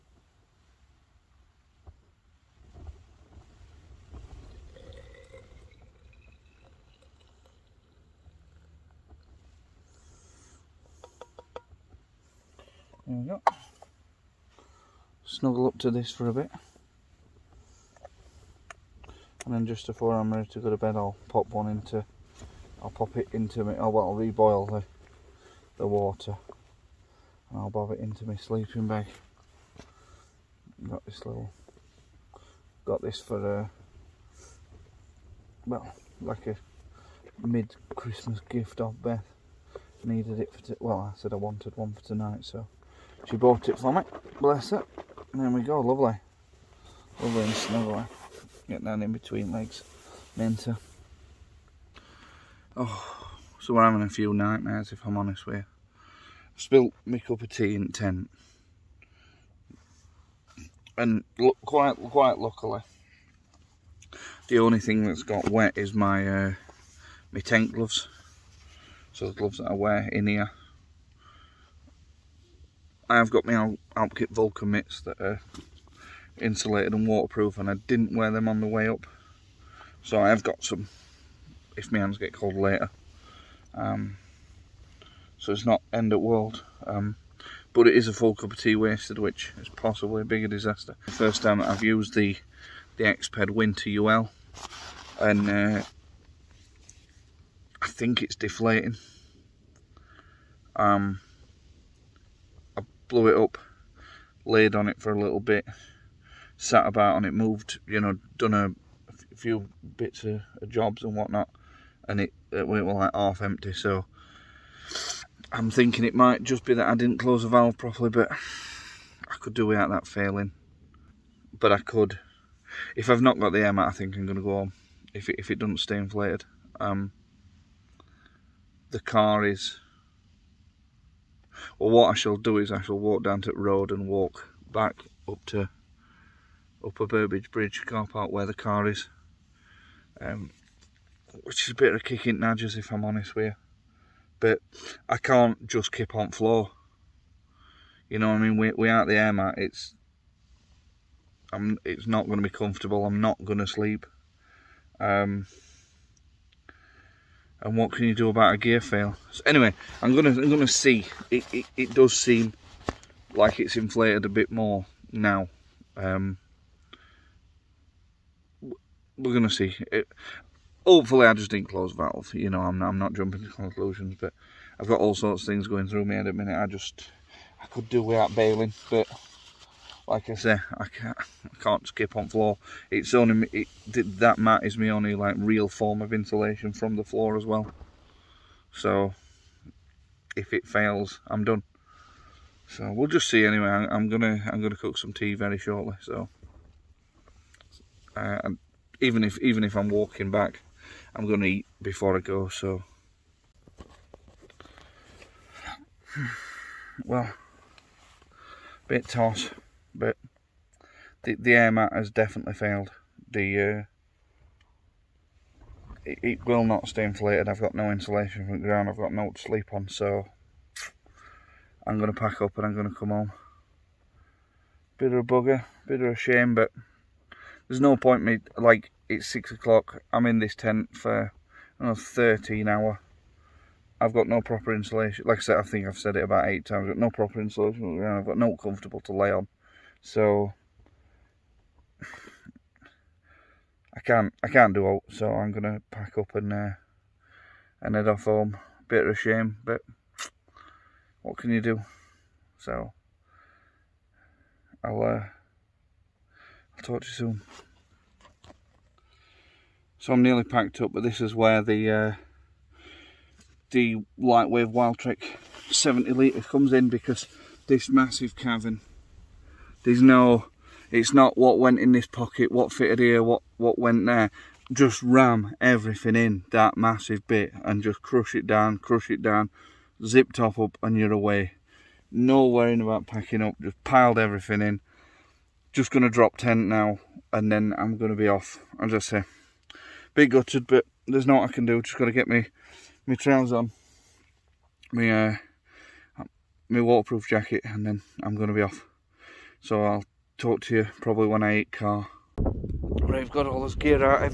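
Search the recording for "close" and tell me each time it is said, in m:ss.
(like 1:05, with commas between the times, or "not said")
1:57, 2:51.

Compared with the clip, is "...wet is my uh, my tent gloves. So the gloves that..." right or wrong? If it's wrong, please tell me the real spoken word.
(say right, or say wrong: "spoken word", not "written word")
right.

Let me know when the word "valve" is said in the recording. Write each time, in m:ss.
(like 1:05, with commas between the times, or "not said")
1:57, 2:51.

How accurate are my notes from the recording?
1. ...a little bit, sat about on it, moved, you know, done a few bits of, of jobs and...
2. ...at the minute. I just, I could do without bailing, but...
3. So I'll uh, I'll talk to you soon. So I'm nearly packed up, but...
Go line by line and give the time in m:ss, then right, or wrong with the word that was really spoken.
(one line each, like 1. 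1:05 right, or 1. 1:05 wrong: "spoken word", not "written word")
1. 1:45 right
2. 2:56 right
3. 4:12 right.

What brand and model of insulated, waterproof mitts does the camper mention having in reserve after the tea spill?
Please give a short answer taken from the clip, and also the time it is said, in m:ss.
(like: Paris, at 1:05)
Alpkit Vulcan, at 1:13.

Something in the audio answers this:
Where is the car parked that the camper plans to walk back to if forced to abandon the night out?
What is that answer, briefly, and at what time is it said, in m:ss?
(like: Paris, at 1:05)
Upper Burbage Bridge car park, at 2:16.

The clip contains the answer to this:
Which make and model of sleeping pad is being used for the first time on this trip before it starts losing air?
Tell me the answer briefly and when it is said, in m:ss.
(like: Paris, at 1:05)
Exped Winter UL, at 1:33.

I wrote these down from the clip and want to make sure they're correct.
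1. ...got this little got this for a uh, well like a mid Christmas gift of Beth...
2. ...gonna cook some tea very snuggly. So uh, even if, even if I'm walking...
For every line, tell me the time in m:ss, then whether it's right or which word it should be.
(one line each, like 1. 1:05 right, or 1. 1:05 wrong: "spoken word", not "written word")
1. 0:30 right
2. 3:14 wrong: "shortly", not "snuggly".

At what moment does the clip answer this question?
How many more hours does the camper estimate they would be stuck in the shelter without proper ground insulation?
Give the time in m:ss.
3:52.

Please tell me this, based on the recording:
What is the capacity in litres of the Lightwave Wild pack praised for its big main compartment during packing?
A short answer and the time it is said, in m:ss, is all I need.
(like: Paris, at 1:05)
70 litres, at 4:25.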